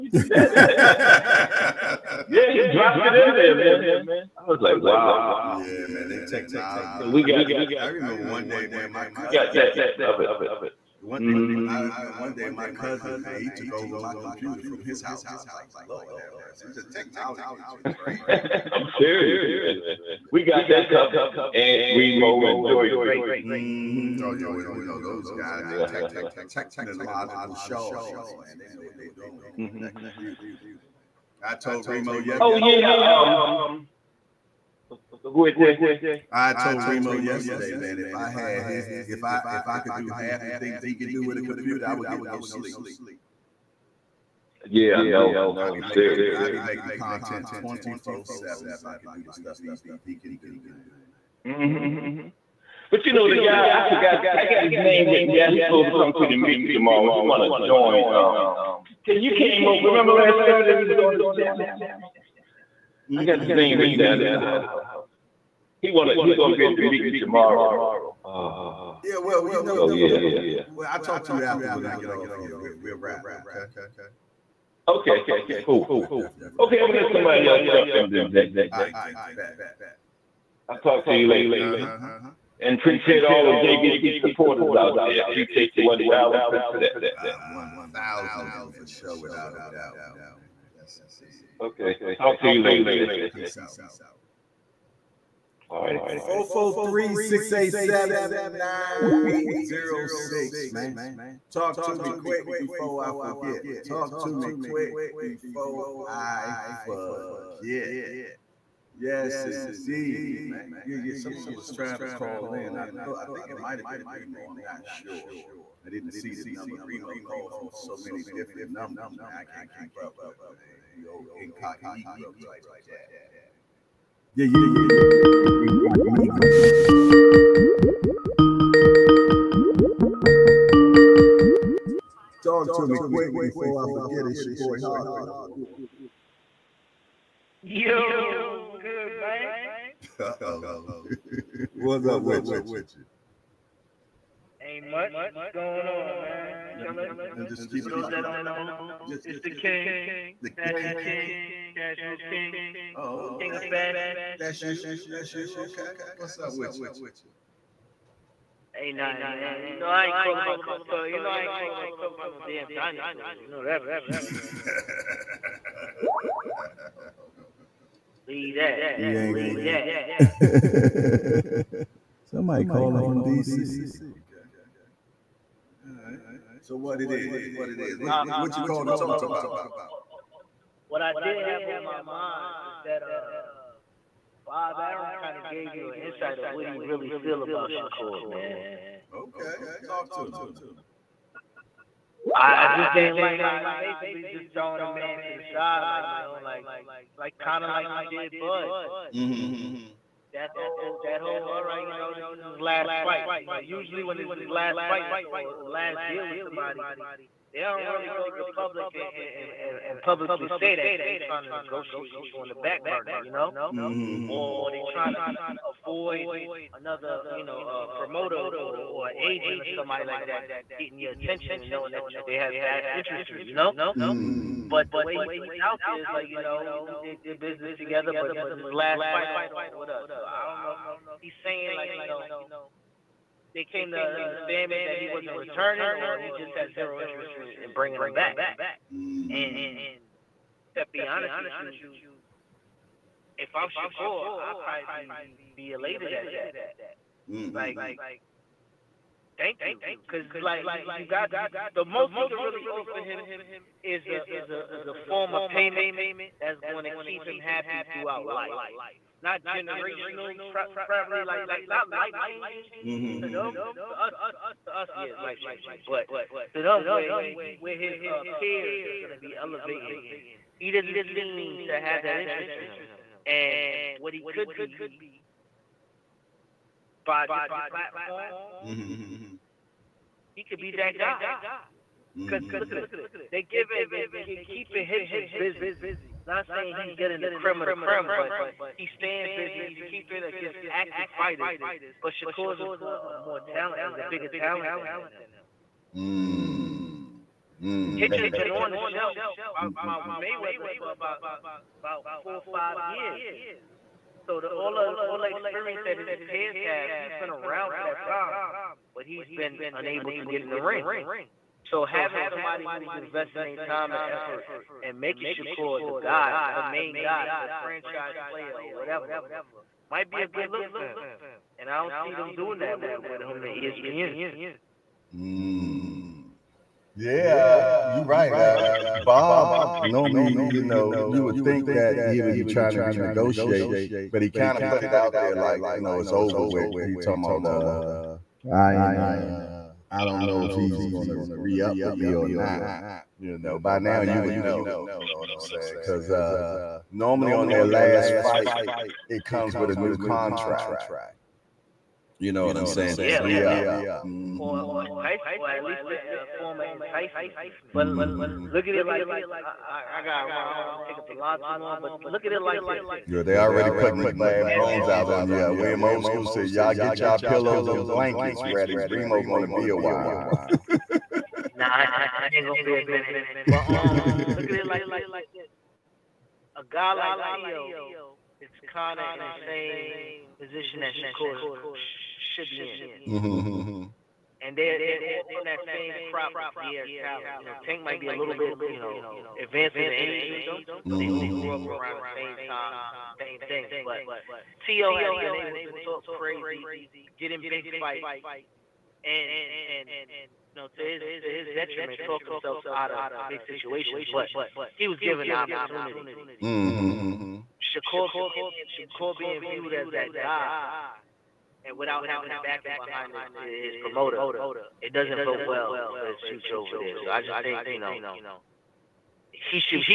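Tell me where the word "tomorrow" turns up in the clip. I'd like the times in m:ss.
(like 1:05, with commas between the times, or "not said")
0:56, 1:07.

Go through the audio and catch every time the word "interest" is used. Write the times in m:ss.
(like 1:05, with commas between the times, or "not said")
3:42, 3:56, 4:32.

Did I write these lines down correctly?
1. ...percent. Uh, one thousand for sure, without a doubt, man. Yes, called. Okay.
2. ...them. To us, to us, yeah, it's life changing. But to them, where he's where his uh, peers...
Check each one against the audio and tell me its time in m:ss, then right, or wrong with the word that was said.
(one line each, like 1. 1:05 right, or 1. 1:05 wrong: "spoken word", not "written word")
1. 1:26 wrong: "indeed", not "called"
2. 4:23 right.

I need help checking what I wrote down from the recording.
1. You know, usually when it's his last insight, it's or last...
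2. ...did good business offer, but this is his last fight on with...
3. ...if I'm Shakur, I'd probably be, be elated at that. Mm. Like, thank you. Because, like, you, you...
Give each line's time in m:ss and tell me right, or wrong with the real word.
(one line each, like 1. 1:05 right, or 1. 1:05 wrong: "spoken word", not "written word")
1. 3:23 wrong: "fight", not "insight"
2. 3:47 wrong: "together", not "offer"
3. 4:03 right.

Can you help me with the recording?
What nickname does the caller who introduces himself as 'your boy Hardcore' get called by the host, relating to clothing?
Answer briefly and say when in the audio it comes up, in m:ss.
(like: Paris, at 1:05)
The Fashion King, at 2:30.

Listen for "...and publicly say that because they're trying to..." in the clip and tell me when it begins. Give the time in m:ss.
3:29.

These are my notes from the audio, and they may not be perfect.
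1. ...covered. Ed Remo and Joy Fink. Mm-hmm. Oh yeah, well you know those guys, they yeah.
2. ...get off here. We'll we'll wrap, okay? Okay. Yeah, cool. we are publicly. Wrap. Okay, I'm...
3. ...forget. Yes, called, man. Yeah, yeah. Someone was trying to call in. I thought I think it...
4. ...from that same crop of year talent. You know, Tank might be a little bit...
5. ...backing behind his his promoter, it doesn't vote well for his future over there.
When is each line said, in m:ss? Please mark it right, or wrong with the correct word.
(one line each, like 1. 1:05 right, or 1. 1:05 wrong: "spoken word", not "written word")
1. 0:20 right
2. 1:11 wrong: "definitely", not "publicly"
3. 1:46 wrong: "indeed", not "called"
4. 6:25 right
5. 6:52 right.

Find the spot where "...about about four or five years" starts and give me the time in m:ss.
5:00.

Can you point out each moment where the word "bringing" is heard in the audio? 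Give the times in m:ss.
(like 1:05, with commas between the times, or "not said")
3:57.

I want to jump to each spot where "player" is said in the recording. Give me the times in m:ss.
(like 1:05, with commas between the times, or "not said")
5:18.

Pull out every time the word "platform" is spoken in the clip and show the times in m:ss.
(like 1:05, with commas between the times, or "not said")
4:37.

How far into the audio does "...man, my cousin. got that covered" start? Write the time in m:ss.
0:08.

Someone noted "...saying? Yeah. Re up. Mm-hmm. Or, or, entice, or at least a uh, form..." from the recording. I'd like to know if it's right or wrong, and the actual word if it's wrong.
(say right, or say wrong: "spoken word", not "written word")
right.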